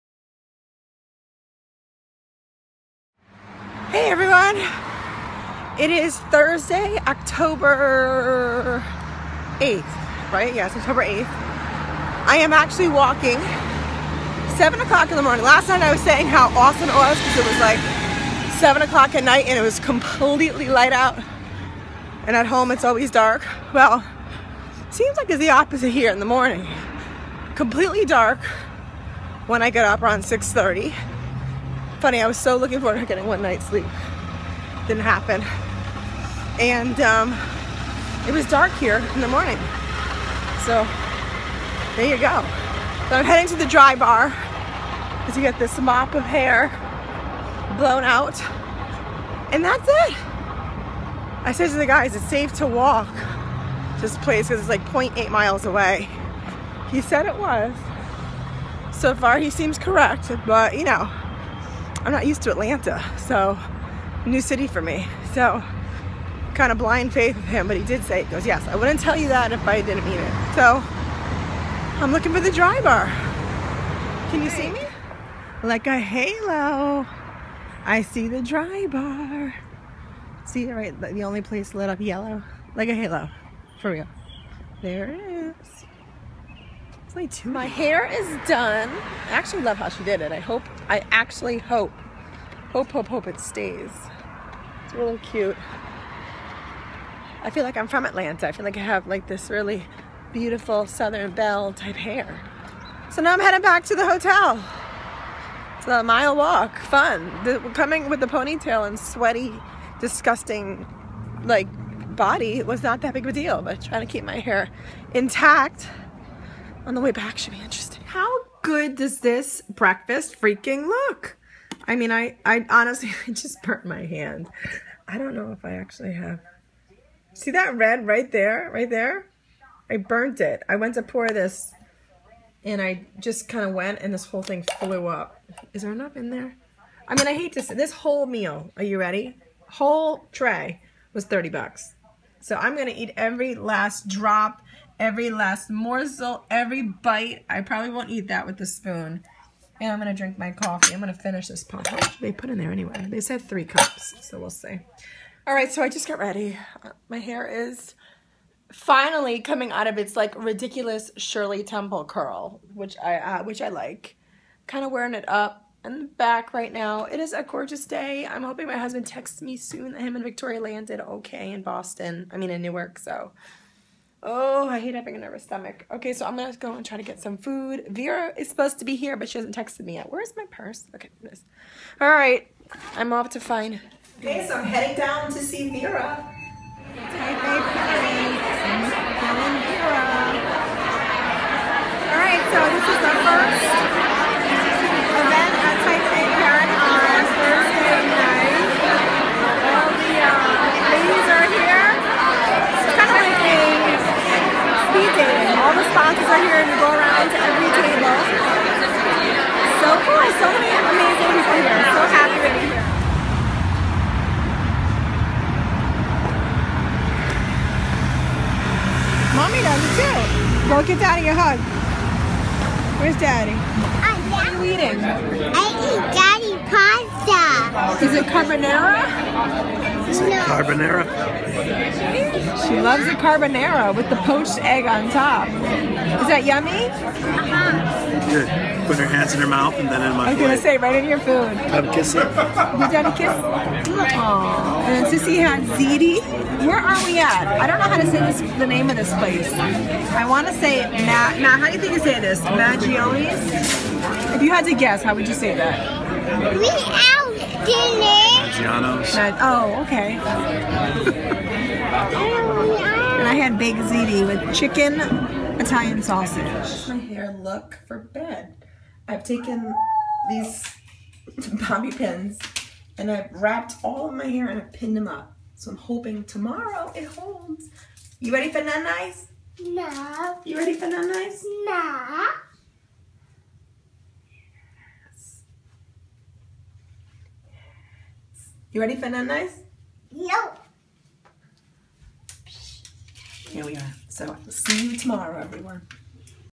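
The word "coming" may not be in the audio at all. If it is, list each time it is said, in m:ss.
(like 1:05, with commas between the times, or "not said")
1:47, 2:39.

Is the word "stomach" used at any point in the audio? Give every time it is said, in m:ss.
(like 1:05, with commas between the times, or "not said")
2:55.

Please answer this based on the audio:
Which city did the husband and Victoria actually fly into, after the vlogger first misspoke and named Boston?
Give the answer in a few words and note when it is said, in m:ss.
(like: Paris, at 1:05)
Newark, at 2:52.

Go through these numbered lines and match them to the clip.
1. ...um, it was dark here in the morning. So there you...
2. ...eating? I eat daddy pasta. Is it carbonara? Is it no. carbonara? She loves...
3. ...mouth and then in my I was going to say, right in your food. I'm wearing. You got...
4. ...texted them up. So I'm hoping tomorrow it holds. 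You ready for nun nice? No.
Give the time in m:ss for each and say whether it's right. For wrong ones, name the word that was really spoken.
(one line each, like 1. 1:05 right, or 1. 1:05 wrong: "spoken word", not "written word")
1. 0:36 right
2. 3:44 right
3. 3:59 wrong: "kissing", not "wearing"
4. 4:34 wrong: "pinned", not "texted".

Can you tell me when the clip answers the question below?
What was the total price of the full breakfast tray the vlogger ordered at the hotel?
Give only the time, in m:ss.
2:21.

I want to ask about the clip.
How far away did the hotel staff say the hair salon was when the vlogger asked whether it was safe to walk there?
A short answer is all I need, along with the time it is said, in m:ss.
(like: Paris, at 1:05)
0.8 miles, at 0:54.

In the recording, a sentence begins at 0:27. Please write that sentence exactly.
Completely dark when I get up around 6.30 funny, I was so looking forward to getting one night's sleep.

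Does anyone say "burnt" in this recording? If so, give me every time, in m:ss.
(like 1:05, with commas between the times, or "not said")
2:03, 2:09.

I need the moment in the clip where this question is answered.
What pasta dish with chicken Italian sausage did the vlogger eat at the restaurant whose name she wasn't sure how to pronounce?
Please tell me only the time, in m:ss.
4:23.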